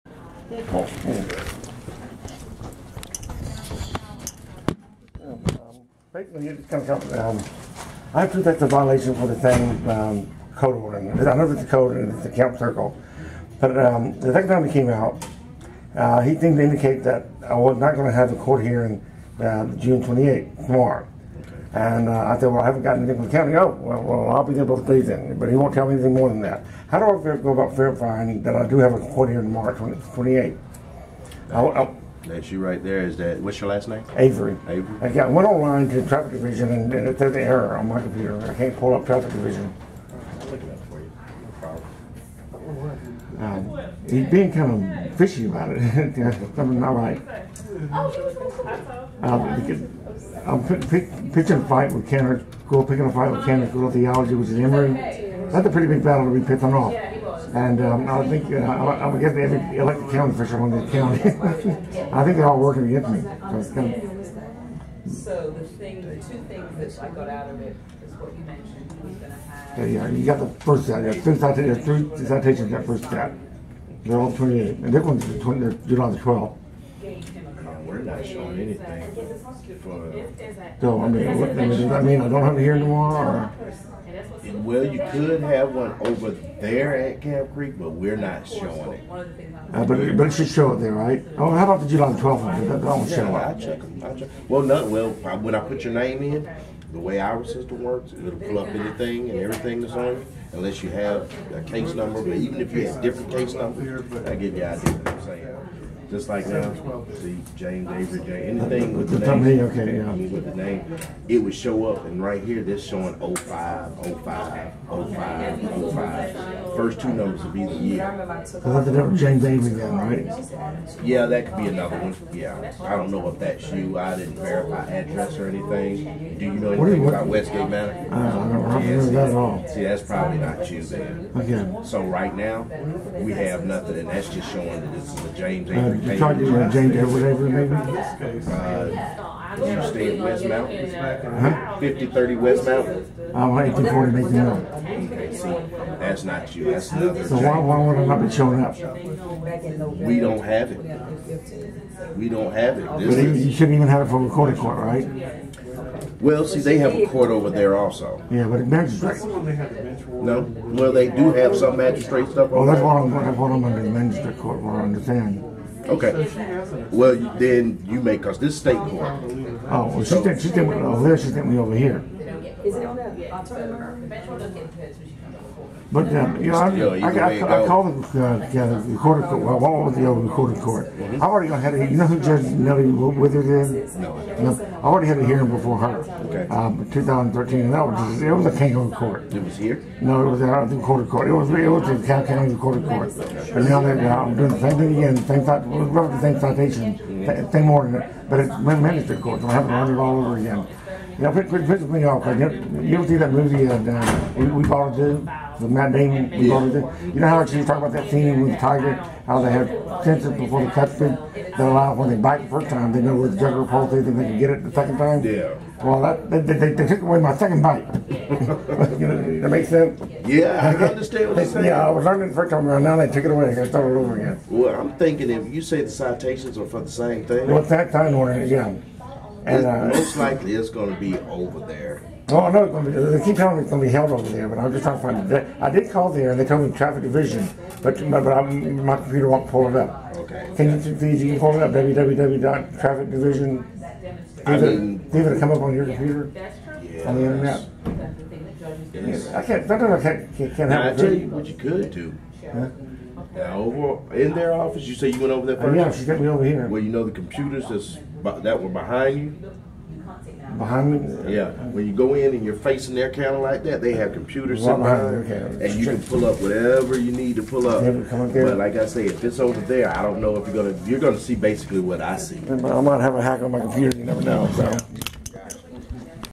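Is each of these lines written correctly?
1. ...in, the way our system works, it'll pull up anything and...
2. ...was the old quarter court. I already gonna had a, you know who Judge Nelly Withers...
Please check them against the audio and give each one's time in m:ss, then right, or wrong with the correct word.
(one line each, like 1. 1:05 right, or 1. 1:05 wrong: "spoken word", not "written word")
1. 1:36 right
2. 2:59 right.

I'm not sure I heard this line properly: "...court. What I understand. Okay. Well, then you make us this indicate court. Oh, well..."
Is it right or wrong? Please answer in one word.
wrong.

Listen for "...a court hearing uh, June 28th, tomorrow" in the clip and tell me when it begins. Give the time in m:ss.
0:18.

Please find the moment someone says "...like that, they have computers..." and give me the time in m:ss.
4:23.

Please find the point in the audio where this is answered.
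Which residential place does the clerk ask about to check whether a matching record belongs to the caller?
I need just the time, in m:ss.
2:07.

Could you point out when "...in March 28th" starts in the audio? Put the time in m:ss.
0:29.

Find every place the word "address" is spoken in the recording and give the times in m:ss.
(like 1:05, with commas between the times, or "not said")
2:04.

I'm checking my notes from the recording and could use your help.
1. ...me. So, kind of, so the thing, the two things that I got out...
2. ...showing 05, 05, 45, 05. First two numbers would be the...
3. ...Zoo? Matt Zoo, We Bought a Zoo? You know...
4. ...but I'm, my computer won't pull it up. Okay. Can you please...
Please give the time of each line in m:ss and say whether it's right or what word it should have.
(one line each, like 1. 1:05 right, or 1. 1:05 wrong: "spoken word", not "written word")
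1. 1:03 right
2. 1:52 wrong: "05", not "45"
3. 3:24 wrong: "Damon", not "Zoo"
4. 3:58 right.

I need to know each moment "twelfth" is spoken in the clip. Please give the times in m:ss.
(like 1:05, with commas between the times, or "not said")
1:32.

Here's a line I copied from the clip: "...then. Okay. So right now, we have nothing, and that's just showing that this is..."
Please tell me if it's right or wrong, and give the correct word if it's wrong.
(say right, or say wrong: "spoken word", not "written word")
right.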